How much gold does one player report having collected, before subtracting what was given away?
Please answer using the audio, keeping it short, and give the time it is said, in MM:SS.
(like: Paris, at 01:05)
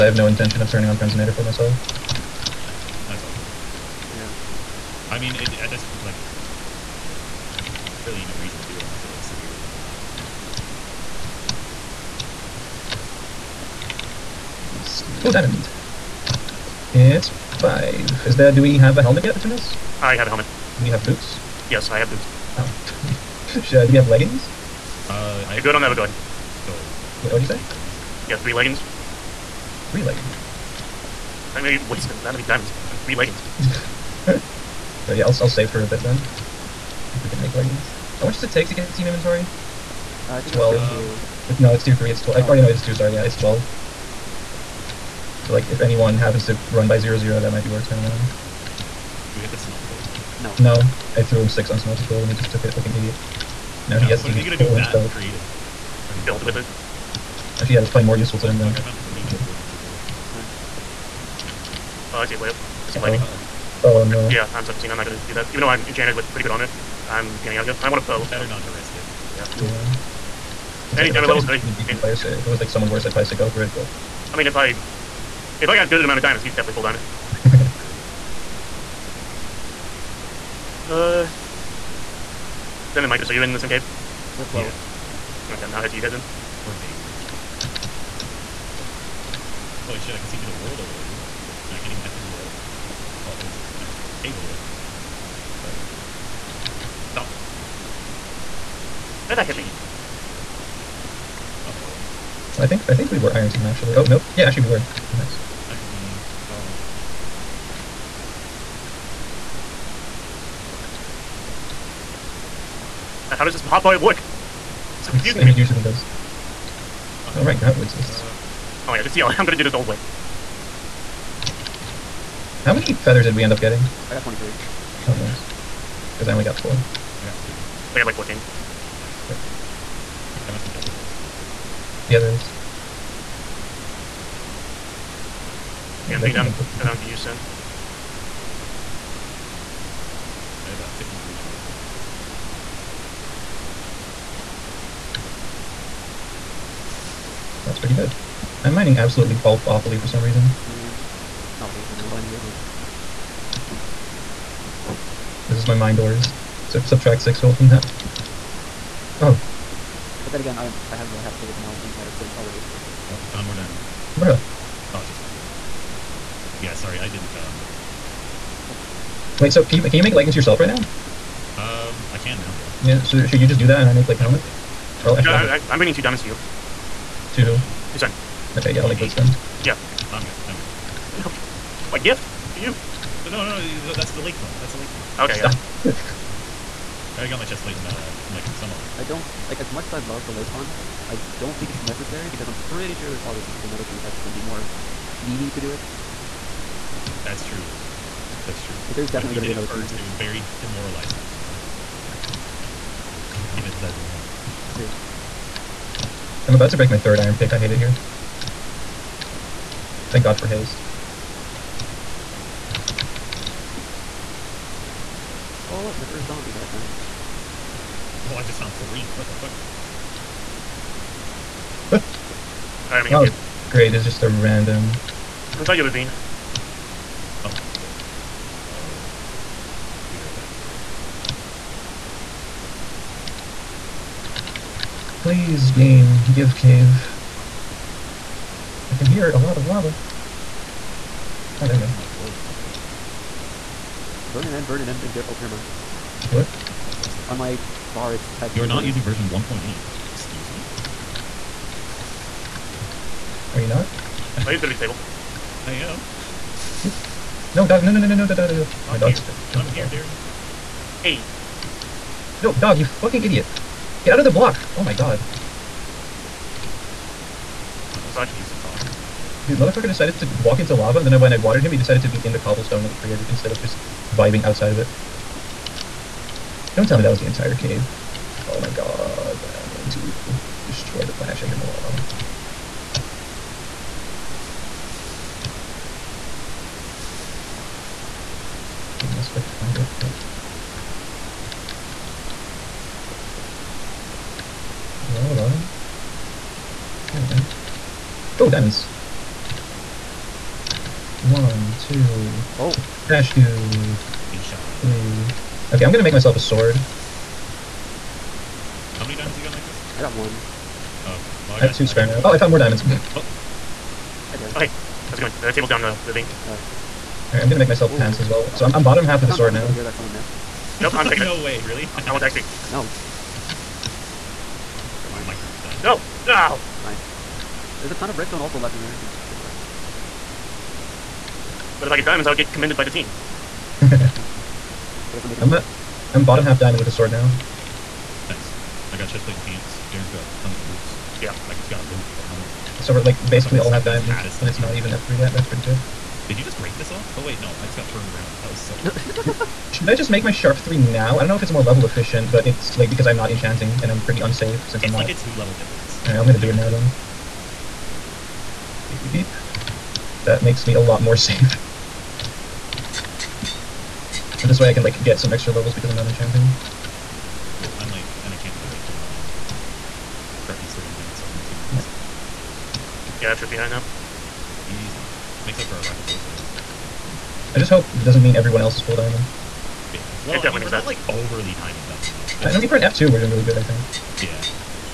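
53, at 02:20.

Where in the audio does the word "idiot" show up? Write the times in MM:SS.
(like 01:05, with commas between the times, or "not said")
00:52, 04:23.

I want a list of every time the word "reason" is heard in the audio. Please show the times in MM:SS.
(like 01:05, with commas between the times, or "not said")
00:08, 02:30.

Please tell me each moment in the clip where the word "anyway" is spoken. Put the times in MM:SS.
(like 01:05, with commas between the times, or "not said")
02:32, 06:11.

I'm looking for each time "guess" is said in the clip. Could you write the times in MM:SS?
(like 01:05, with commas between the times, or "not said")
04:49, 05:35, 06:16.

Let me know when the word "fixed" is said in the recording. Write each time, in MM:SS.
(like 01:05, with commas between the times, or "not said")
04:06.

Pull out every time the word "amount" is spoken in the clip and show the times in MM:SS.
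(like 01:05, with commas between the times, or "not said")
01:16.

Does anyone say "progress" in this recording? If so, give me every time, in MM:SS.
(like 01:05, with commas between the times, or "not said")
not said.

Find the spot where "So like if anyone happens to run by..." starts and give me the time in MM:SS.
00:45.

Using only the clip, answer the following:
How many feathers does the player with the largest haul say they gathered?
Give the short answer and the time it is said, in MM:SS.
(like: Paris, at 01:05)
23, at 02:04.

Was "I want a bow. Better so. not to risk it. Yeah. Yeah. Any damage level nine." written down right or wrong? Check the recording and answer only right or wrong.
wrong.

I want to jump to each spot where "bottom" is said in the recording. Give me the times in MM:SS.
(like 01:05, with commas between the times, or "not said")
05:18, 05:36.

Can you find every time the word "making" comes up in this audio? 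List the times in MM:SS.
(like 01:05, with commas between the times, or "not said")
05:35.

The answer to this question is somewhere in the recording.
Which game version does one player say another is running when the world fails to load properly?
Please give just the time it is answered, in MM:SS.
04:09.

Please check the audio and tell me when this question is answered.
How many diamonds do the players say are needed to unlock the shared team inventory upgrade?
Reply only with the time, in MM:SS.
00:40.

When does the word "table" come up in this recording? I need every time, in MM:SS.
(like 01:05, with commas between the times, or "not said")
04:14, 05:15.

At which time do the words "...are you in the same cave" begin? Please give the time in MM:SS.
01:23.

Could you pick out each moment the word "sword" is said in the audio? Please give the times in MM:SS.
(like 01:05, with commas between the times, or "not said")
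05:06, 05:19, 05:36, 06:11.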